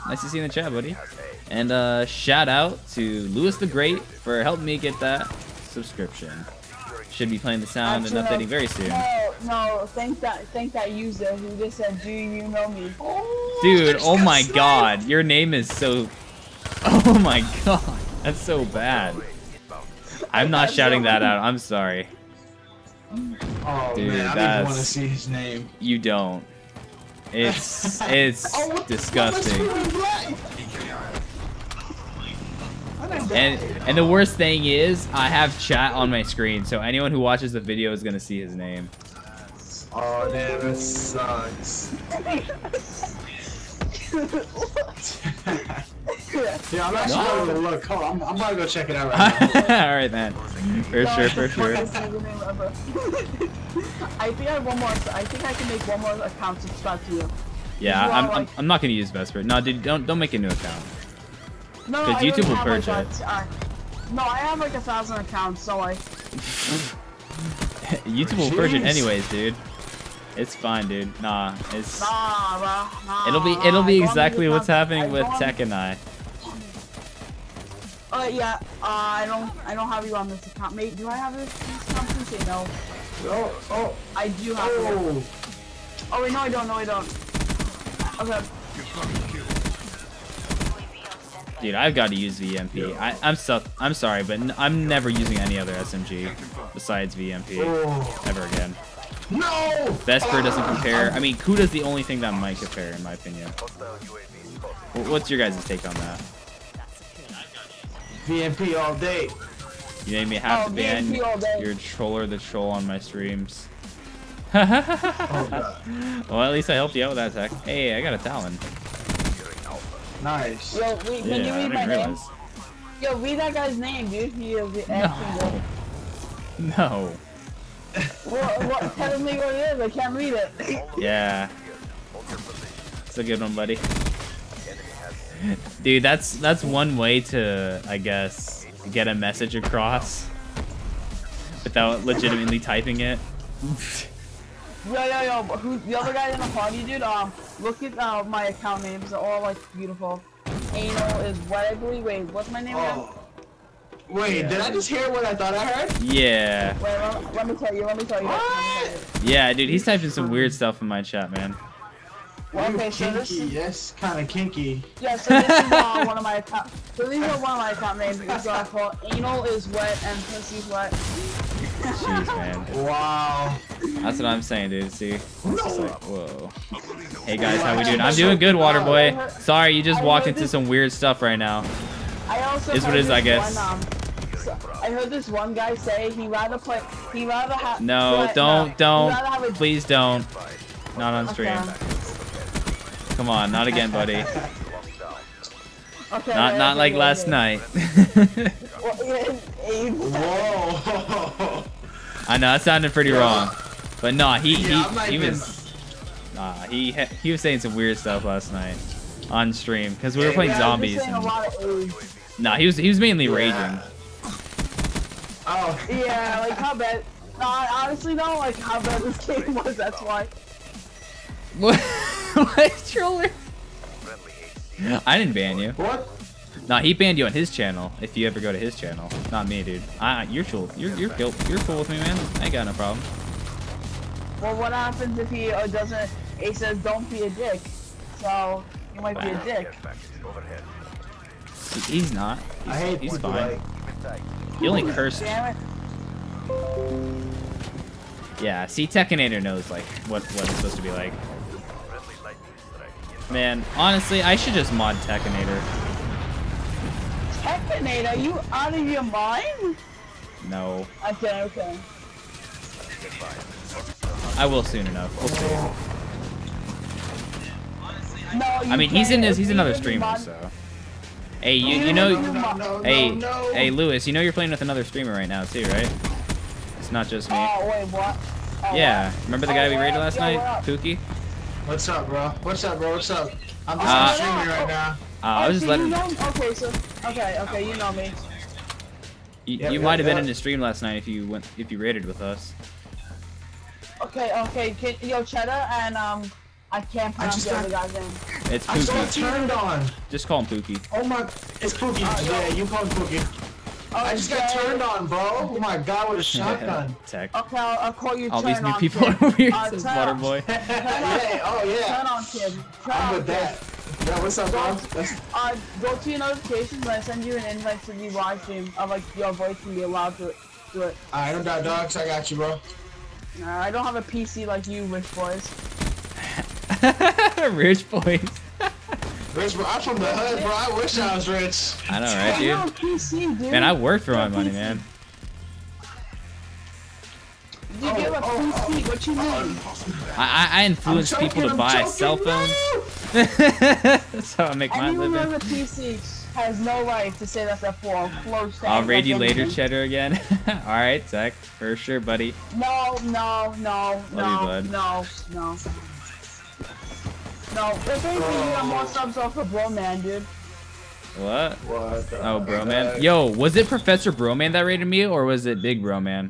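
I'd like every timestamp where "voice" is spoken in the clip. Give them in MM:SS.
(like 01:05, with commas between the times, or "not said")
05:19.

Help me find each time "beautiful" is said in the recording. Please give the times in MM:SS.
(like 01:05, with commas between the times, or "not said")
02:29.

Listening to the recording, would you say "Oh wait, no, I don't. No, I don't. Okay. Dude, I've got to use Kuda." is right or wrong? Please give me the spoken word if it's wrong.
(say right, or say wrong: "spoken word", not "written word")
wrong: "VMP", not "Kuda".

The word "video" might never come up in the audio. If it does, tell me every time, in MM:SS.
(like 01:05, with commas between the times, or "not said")
00:37.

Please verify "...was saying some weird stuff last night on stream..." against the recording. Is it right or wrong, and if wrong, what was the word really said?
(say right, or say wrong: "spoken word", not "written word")
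right.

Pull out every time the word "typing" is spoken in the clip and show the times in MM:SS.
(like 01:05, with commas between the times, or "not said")
02:22, 02:39.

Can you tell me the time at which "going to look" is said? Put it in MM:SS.
00:47.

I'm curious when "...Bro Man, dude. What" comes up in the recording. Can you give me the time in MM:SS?
05:59.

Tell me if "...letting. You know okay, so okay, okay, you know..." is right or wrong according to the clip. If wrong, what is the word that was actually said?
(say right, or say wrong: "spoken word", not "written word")
right.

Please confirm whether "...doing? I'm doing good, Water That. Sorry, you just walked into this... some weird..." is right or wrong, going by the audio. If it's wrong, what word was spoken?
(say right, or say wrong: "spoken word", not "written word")
wrong: "Boy", not "That".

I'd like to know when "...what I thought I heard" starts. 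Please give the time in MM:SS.
02:35.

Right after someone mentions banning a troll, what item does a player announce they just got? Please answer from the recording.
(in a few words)
A Talon.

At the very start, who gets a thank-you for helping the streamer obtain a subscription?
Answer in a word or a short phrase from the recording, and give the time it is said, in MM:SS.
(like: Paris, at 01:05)
Lewis the Great, at 00:03.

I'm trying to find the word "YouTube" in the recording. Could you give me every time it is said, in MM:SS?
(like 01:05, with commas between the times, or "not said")
01:02, 01:08.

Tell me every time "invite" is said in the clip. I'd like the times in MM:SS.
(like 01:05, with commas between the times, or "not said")
05:17.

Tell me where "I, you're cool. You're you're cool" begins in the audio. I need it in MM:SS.
03:50.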